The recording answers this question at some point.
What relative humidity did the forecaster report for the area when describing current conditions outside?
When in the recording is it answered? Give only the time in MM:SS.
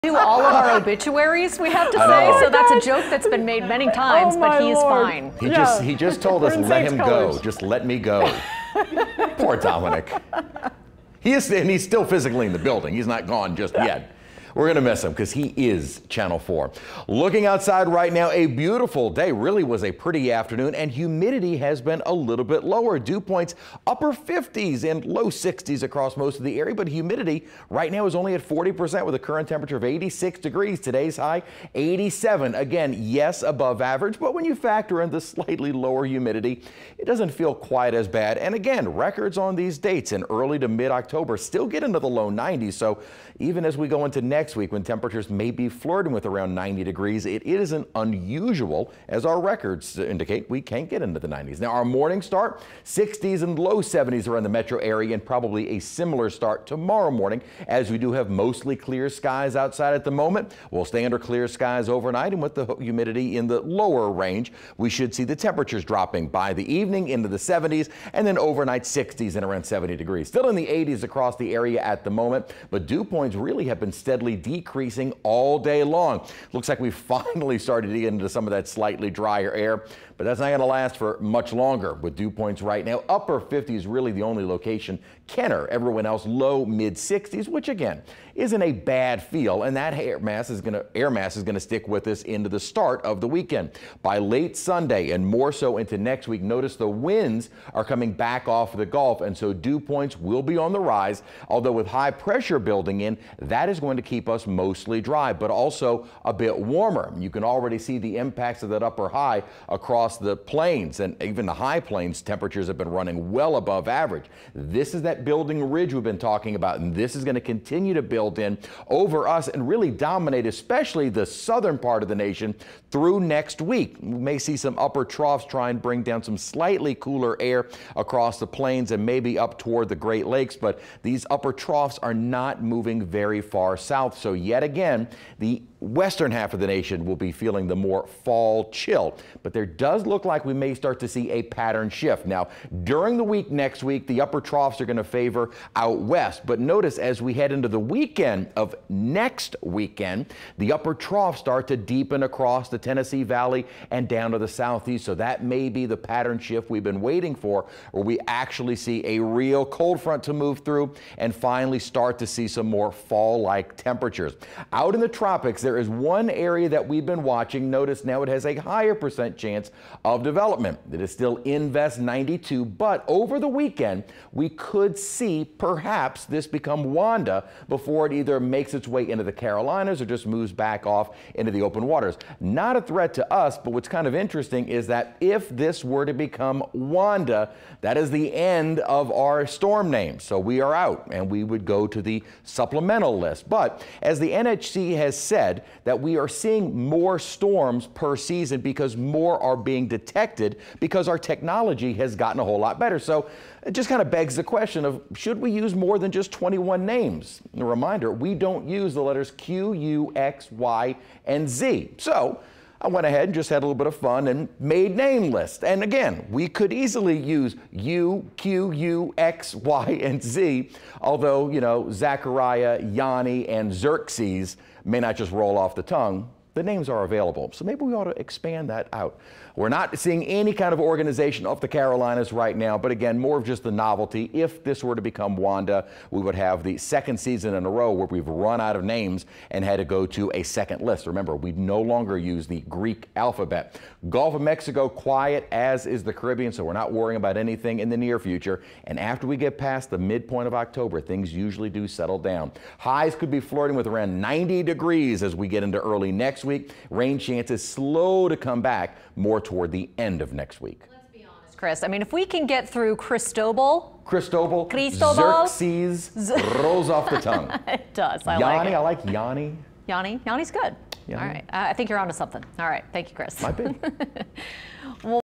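00:28.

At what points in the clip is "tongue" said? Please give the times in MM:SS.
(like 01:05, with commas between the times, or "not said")
03:45, 04:27.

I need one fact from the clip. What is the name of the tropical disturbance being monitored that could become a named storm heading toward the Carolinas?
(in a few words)
Invest 92.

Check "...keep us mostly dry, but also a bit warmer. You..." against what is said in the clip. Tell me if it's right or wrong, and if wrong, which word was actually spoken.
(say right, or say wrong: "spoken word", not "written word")
right.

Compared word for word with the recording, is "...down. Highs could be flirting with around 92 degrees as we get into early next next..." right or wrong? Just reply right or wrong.
wrong.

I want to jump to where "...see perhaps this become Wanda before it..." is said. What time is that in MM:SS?
02:54.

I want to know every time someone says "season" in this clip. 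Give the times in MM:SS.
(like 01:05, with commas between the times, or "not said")
03:18, 03:57.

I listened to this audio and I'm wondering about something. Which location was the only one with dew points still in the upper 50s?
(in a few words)
Kenner.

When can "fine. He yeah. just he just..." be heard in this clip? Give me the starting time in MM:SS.
00:05.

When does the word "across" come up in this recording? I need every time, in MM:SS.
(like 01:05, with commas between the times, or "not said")
00:25, 01:11, 01:49, 02:07, 02:32.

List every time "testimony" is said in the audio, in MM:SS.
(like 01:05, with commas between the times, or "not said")
not said.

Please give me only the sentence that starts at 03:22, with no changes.
So it just kind of begs the question of should we use more than just 21 names?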